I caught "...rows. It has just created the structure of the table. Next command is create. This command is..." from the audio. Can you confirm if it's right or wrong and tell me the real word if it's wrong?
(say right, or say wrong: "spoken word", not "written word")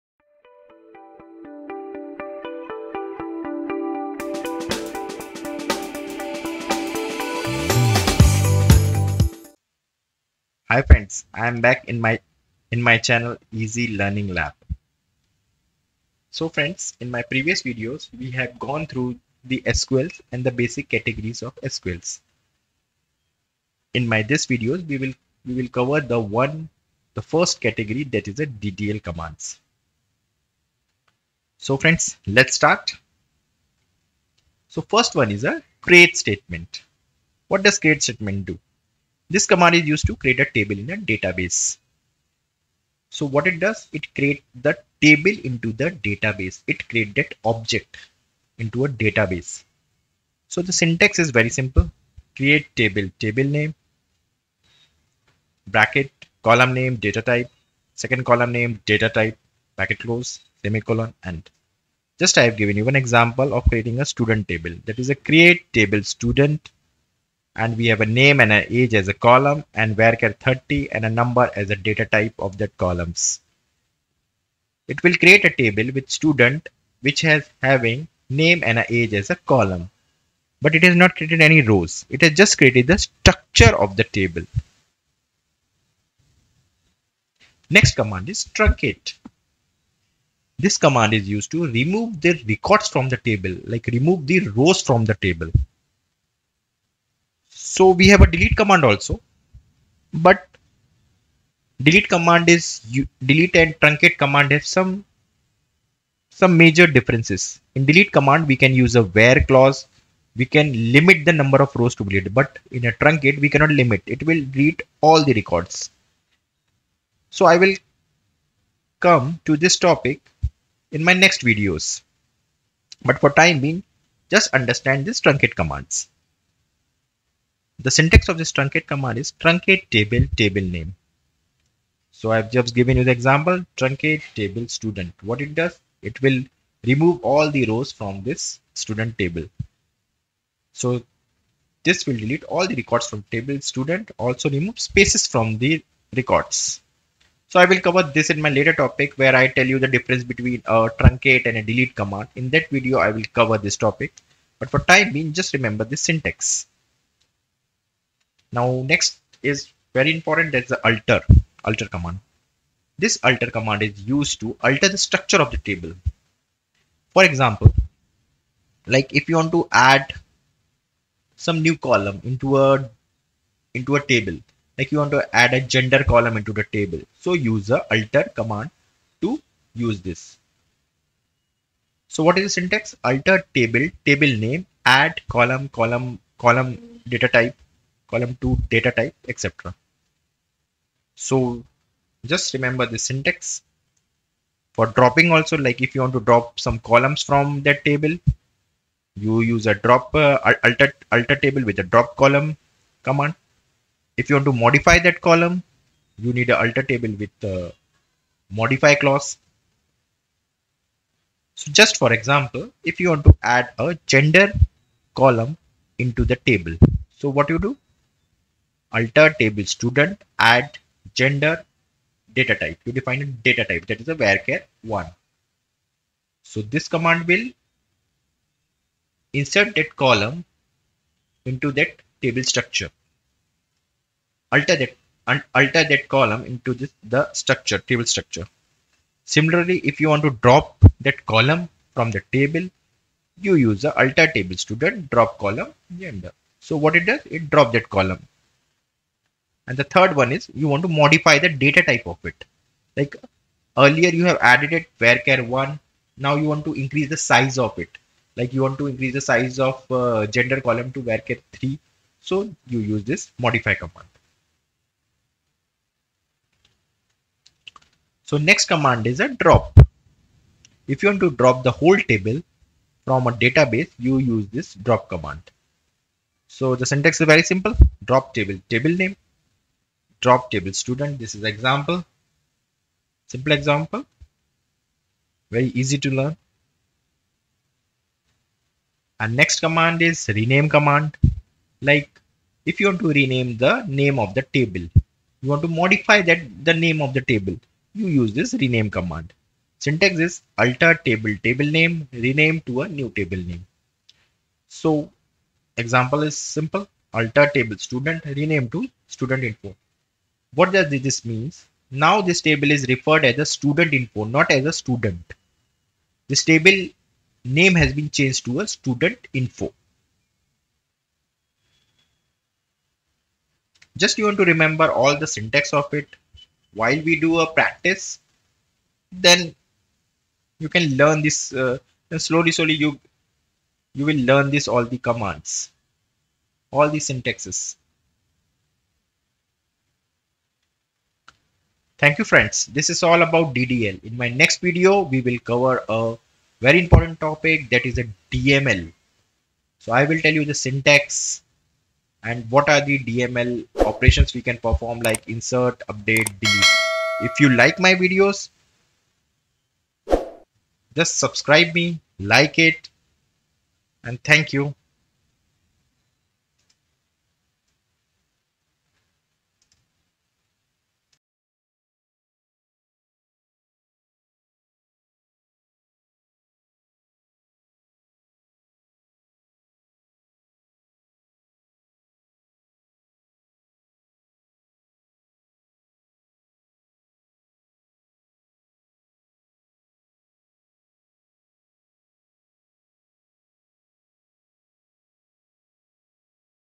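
wrong: "truncate", not "create".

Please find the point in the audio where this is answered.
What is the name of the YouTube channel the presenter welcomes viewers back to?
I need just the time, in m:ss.
0:13.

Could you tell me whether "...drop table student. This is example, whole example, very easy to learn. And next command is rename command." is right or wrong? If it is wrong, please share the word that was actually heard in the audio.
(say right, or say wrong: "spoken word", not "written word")
wrong: "simple", not "whole".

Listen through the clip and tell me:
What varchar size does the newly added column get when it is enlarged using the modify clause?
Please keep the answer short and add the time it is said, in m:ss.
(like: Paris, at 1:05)
3, at 4:21.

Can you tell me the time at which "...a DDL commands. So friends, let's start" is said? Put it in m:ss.
0:28.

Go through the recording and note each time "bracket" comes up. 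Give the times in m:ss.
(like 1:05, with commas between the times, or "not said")
0:55, 0:59.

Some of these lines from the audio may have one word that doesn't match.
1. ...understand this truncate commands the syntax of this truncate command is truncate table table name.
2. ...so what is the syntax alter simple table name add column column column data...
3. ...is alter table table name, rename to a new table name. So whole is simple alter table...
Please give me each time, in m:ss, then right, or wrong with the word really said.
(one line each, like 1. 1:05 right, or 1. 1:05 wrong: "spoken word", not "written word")
1. 2:04 right
2. 3:02 wrong: "table", not "simple"
3. 5:00 wrong: "example", not "whole".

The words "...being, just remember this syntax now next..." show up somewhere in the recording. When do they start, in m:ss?
2:35.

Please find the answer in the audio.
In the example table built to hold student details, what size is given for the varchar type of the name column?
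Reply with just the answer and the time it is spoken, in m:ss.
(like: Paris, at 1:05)
30, at 1:10.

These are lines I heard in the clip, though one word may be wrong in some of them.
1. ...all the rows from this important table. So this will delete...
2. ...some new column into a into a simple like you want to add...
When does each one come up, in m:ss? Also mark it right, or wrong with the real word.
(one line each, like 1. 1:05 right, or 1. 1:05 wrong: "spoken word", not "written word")
1. 2:17 wrong: "student", not "important"
2. 2:51 wrong: "table", not "simple".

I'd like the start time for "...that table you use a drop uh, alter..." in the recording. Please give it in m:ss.
3:17.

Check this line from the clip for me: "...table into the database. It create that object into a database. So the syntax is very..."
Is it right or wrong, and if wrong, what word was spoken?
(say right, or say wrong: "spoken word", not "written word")
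right.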